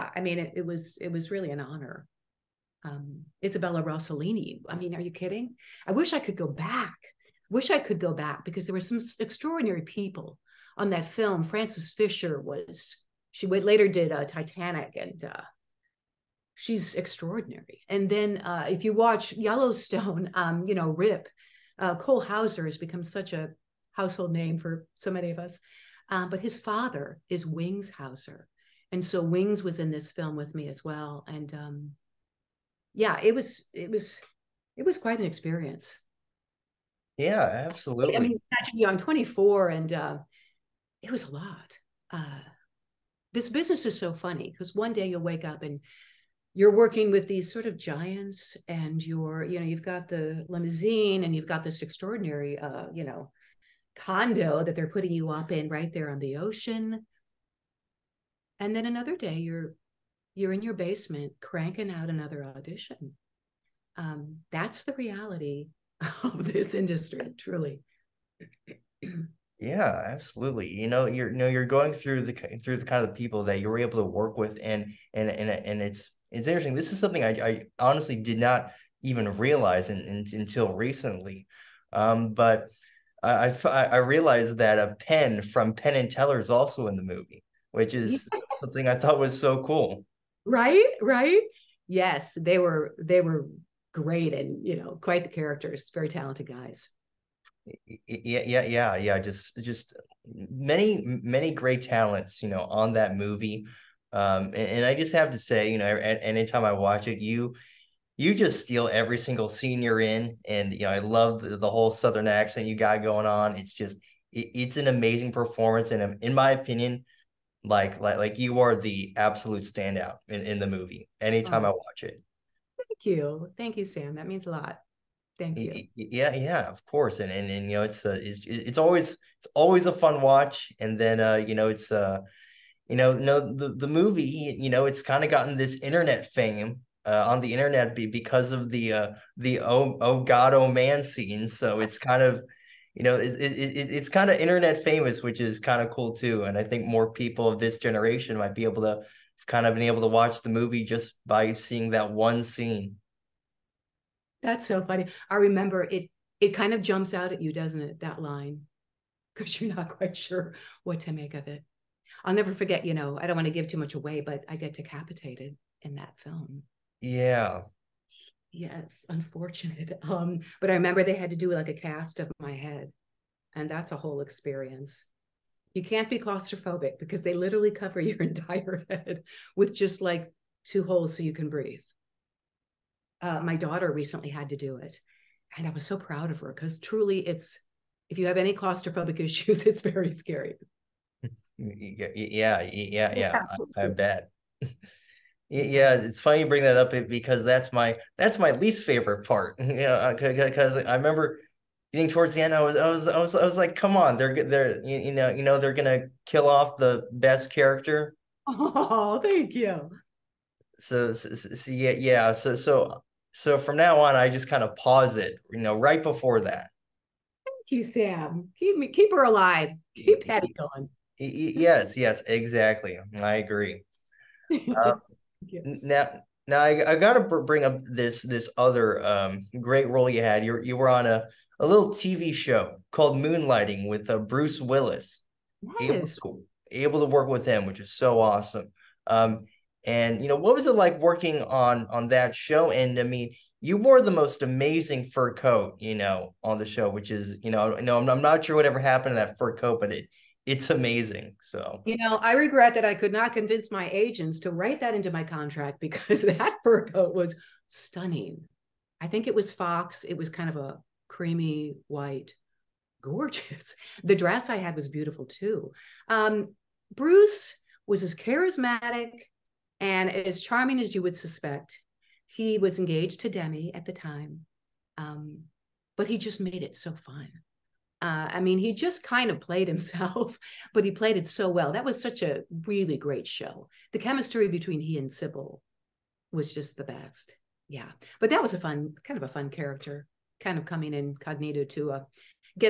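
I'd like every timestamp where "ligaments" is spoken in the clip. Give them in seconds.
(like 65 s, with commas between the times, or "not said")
not said.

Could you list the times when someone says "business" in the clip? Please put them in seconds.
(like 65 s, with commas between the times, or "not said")
43 s.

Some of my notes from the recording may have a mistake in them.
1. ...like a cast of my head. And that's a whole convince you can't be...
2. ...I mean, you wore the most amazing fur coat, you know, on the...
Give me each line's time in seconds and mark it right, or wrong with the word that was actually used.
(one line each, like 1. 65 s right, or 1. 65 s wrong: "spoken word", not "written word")
1. 171 s wrong: "experience", not "convince"
2. 242 s right.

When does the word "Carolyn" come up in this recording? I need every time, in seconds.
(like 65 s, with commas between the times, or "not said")
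not said.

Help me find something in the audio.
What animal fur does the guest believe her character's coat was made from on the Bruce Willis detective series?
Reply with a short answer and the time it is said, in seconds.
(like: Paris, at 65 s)
Fox, at 259 s.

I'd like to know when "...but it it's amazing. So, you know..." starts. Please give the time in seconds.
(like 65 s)
249 s.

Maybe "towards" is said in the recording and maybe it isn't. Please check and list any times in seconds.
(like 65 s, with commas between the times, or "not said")
202 s.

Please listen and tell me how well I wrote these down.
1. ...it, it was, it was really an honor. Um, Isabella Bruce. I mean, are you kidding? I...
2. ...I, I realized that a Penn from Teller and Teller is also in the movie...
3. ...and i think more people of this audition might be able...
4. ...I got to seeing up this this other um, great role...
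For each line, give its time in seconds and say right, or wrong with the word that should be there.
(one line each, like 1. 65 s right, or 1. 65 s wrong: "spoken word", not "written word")
1. 0 s wrong: "Rossellini", not "Bruce"
2. 83 s wrong: "Penn", not "Teller"
3. 146 s wrong: "generation", not "audition"
4. 226 s wrong: "bring", not "seeing".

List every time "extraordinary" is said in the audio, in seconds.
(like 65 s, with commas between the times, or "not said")
9 s, 16 s, 51 s.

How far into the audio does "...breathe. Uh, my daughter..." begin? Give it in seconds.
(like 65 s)
181 s.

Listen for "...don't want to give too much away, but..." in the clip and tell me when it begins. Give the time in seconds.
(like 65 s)
163 s.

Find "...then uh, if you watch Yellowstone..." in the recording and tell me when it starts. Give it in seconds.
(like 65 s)
18 s.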